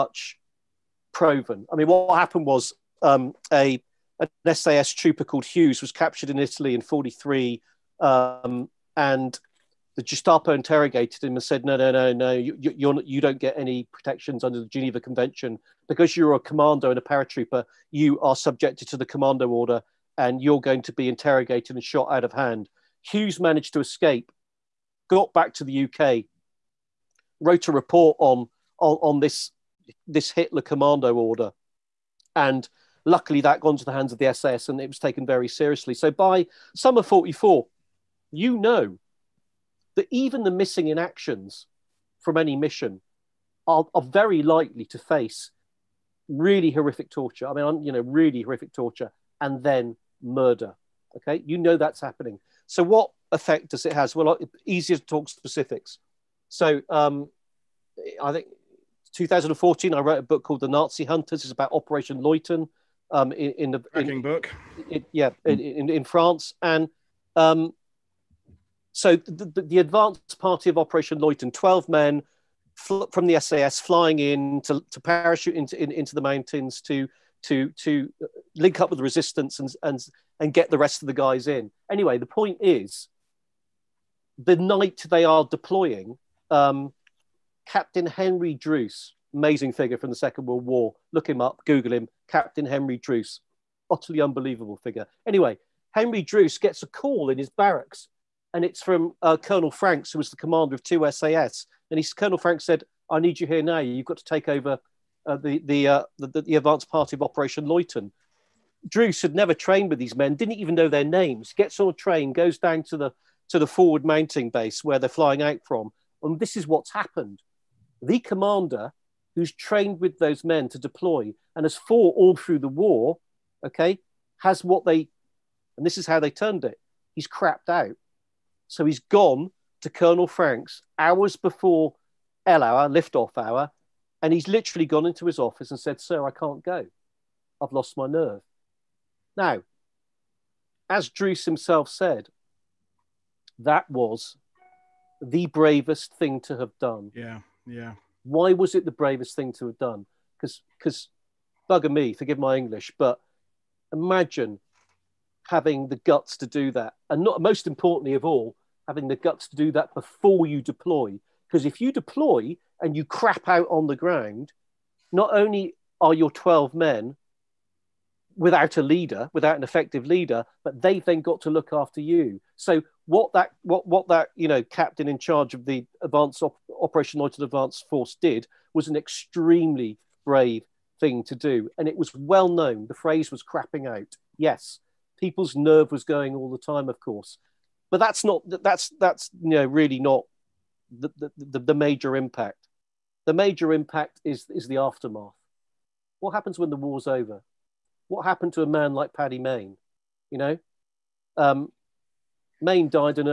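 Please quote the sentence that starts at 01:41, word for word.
And he, Colonel Franks said, I need you here now.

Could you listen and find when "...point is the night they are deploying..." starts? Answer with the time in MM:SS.
01:22.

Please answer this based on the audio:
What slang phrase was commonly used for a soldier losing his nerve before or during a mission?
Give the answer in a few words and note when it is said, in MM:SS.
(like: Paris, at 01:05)
crapping out, at 03:03.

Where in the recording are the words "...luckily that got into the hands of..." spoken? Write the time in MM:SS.
00:33.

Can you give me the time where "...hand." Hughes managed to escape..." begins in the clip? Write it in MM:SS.
00:22.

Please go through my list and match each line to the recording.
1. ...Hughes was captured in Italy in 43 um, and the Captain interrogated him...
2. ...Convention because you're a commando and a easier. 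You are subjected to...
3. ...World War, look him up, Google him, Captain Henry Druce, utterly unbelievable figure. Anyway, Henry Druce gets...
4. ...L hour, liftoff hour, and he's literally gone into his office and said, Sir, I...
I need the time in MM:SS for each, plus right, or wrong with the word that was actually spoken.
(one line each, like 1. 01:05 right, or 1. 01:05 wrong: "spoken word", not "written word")
1. 00:05 wrong: "Gestapo", not "Captain"
2. 00:14 wrong: "paratrooper", not "easier"
3. 01:30 right
4. 02:12 right.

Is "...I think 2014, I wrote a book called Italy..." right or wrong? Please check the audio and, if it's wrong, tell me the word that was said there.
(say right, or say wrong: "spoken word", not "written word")
wrong: "The", not "Italy".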